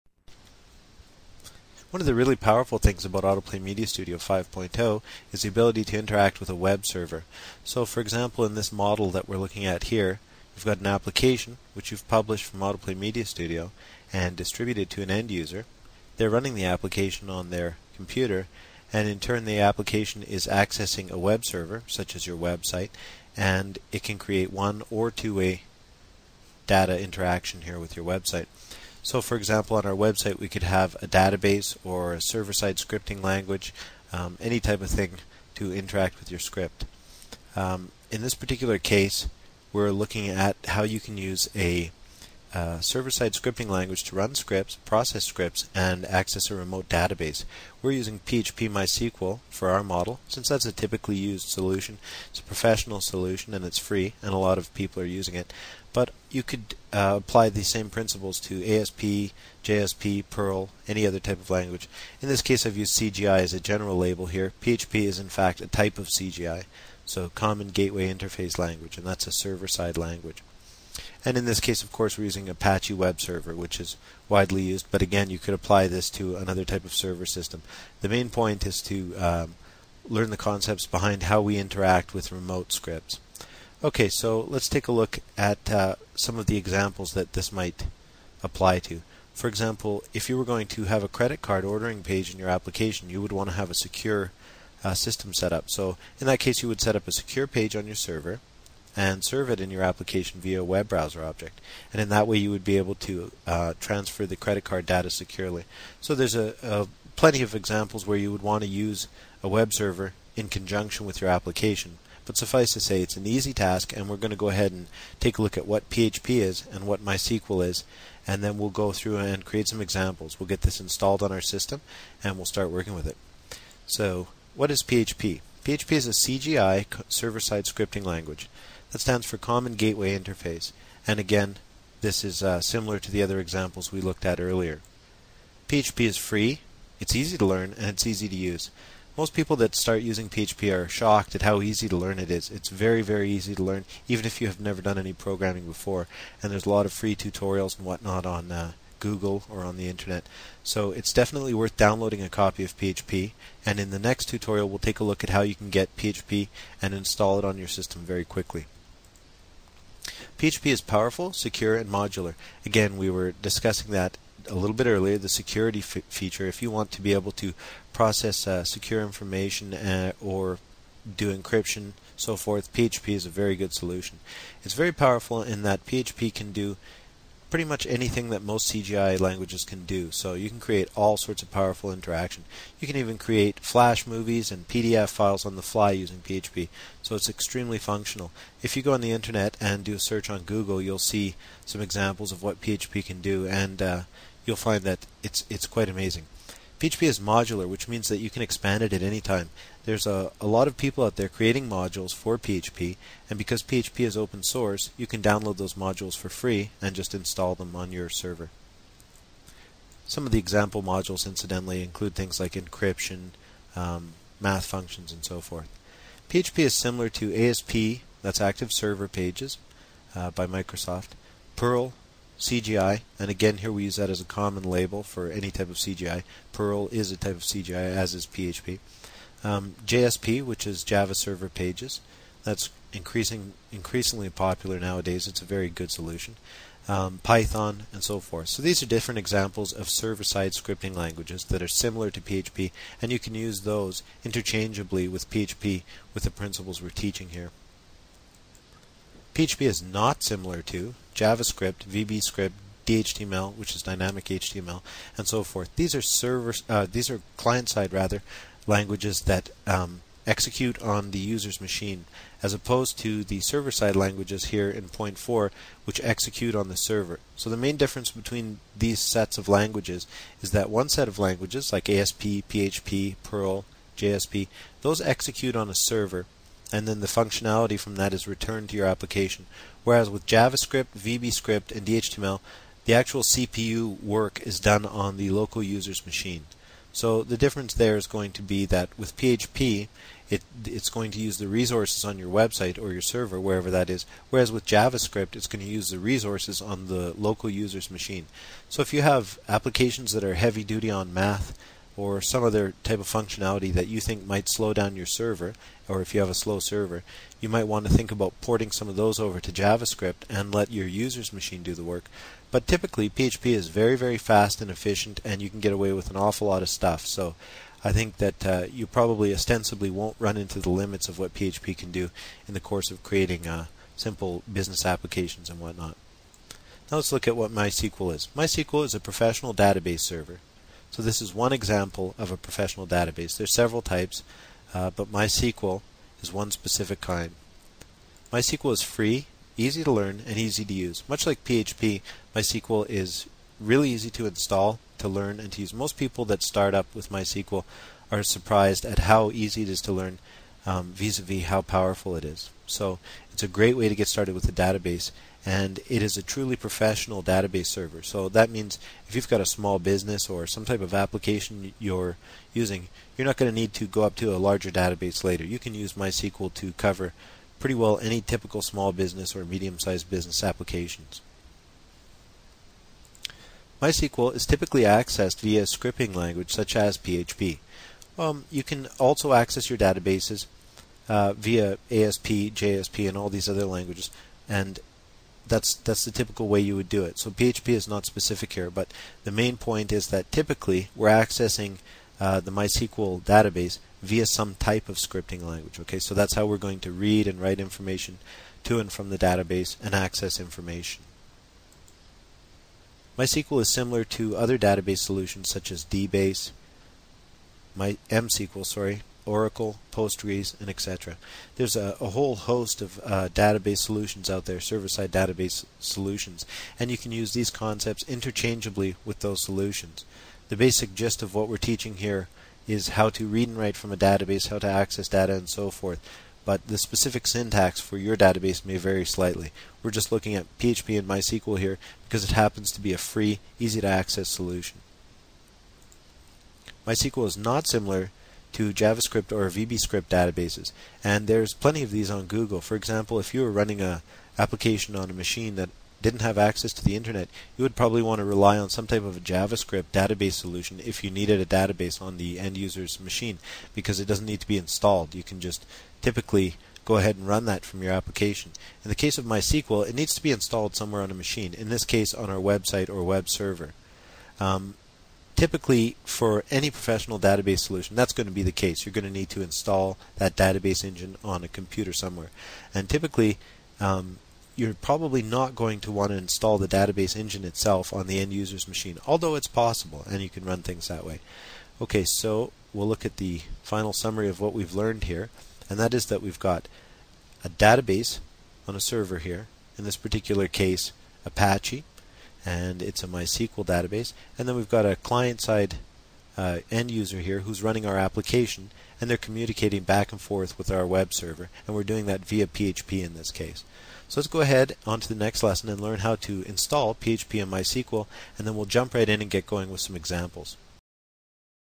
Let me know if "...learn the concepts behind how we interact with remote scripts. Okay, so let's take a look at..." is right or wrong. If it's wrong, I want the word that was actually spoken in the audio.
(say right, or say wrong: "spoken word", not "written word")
right.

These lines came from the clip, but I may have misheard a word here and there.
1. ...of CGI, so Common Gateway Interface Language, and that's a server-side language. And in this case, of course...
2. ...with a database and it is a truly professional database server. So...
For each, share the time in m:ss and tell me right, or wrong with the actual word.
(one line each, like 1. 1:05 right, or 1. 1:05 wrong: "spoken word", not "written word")
1. 1:05 right
2. 5:54 right.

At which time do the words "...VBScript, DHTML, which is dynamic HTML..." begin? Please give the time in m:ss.
4:11.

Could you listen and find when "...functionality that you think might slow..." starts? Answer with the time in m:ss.
5:03.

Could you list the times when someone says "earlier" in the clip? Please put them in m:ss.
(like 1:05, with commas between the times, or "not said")
2:14, 2:44.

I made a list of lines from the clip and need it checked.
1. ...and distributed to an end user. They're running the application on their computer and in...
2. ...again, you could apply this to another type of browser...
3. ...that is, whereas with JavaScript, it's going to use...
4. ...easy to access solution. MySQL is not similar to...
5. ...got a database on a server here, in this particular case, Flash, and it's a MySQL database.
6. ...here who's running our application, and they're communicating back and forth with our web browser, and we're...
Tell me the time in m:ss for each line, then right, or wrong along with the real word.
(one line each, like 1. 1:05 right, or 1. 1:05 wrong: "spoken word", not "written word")
1. 0:14 right
2. 1:15 wrong: "server", not "browser"
3. 4:53 right
4. 7:13 right
5. 8:06 wrong: "Apache", not "Flash"
6. 8:17 wrong: "server", not "browser".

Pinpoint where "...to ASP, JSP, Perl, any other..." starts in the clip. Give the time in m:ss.
0:58.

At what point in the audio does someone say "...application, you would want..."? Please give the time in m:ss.
1:32.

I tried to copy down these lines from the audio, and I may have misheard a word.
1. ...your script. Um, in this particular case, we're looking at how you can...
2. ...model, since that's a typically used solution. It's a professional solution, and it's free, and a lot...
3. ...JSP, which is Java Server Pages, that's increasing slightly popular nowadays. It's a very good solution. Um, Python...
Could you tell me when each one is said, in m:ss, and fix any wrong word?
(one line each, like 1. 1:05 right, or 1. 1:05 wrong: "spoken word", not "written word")
1. 0:36 right
2. 0:49 right
3. 3:49 wrong: "increasingly", not "slightly".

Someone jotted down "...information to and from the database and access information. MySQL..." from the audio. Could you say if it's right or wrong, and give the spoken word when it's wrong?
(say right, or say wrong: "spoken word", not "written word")
right.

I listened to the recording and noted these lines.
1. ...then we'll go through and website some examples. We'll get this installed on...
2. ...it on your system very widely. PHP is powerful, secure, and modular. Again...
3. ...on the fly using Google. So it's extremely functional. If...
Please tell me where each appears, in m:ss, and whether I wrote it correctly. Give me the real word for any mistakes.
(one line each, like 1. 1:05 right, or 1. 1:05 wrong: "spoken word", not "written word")
1. 1:58 wrong: "create", not "website"
2. 2:37 wrong: "quickly", not "widely"
3. 3:05 wrong: "PHP", not "Google".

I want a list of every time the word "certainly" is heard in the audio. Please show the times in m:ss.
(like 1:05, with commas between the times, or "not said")
not said.